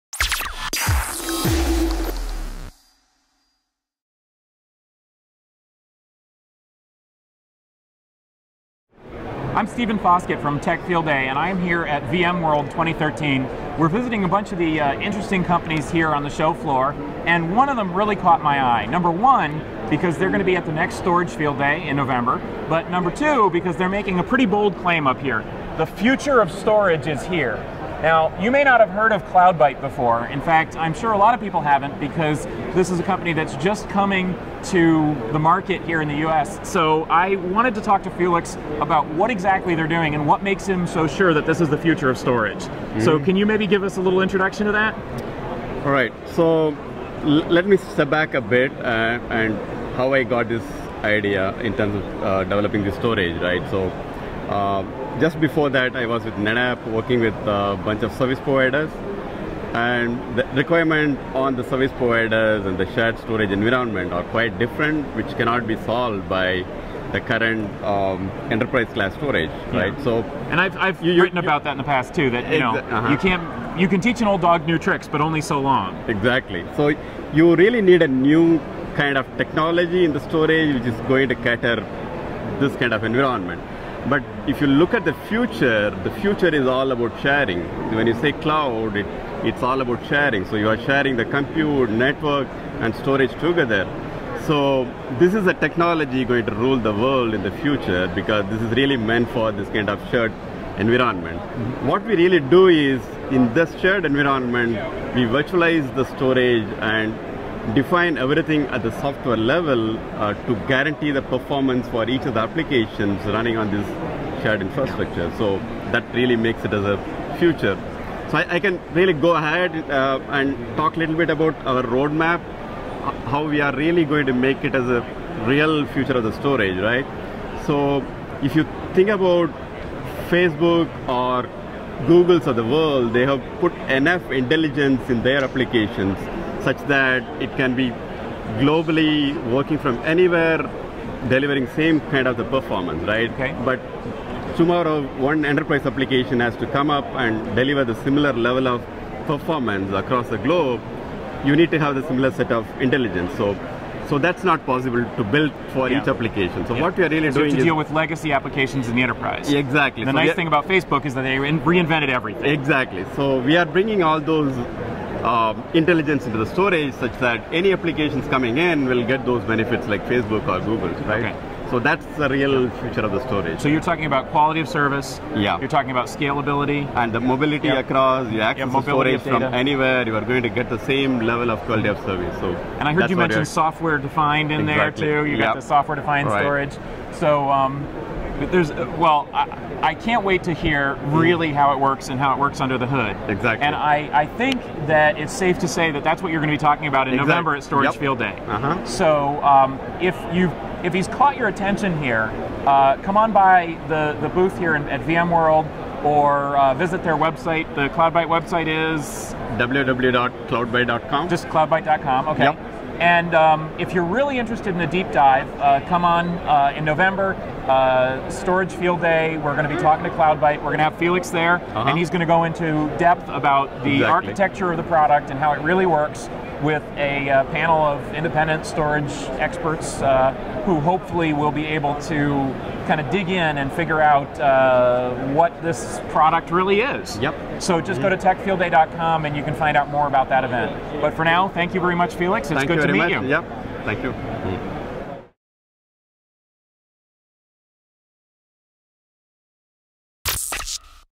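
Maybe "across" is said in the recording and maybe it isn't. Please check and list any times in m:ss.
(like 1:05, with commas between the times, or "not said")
2:29, 2:57.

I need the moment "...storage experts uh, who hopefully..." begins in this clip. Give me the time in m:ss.
3:48.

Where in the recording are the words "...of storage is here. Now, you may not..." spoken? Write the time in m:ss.
0:26.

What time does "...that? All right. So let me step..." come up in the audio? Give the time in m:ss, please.
0:44.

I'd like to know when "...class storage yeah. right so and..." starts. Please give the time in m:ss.
1:08.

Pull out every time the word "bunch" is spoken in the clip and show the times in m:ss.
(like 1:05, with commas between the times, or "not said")
0:14, 0:57.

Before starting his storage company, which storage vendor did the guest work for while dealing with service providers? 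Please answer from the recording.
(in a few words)
NetApp.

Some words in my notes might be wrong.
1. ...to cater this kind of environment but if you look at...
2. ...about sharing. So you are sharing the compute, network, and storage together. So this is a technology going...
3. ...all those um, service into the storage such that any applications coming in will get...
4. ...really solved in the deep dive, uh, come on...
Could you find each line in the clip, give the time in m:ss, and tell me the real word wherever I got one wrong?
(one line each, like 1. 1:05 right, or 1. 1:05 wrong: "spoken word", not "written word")
1. 1:21 right
2. 1:29 right
3. 2:44 wrong: "intelligence", not "service"
4. 3:34 wrong: "interested", not "solved".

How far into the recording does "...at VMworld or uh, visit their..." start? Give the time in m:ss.
3:24.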